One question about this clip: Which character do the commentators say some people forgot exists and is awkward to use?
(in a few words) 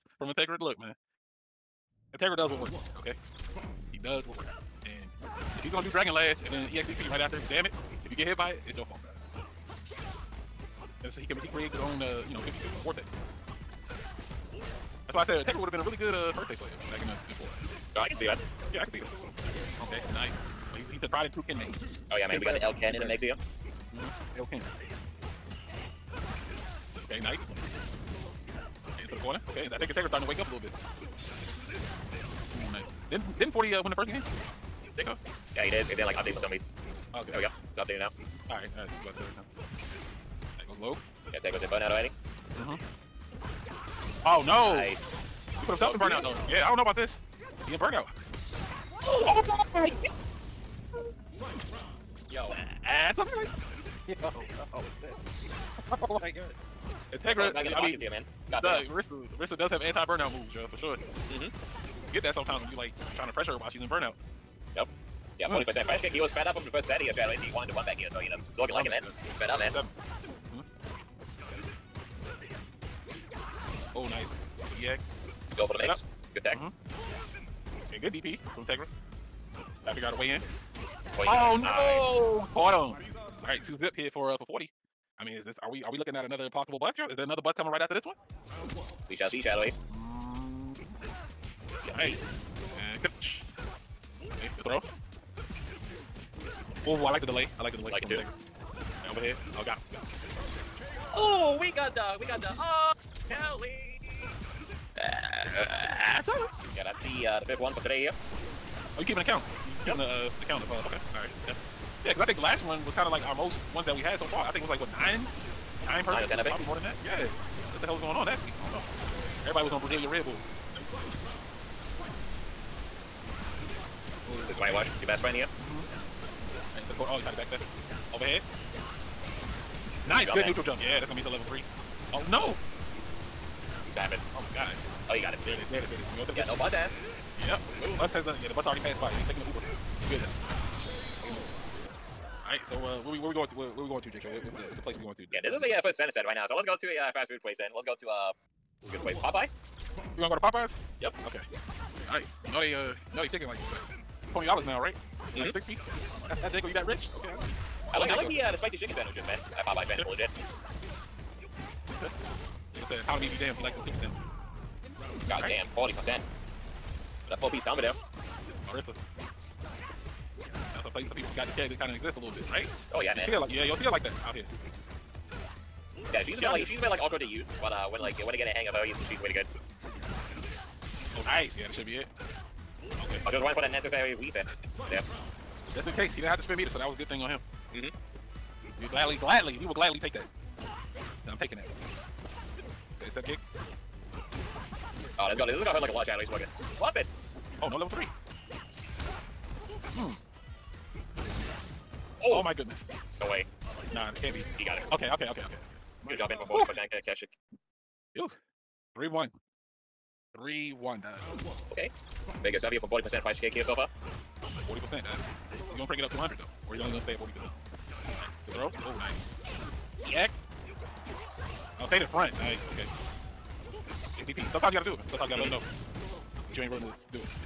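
Marisa.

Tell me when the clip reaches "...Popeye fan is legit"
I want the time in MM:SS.
02:39.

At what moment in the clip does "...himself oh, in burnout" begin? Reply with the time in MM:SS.
00:45.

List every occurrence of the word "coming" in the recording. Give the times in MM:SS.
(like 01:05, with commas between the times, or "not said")
01:27.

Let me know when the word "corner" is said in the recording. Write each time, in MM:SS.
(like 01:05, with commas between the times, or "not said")
00:29.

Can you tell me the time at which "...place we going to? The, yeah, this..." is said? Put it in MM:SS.
02:24.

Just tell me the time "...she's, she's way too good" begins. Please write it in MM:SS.
02:58.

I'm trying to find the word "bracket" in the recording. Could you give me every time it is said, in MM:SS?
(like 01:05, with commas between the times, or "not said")
not said.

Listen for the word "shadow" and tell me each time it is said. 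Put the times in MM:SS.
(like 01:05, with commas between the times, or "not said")
01:07, 01:29, 03:16.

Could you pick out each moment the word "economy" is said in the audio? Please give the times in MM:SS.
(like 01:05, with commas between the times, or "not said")
02:43.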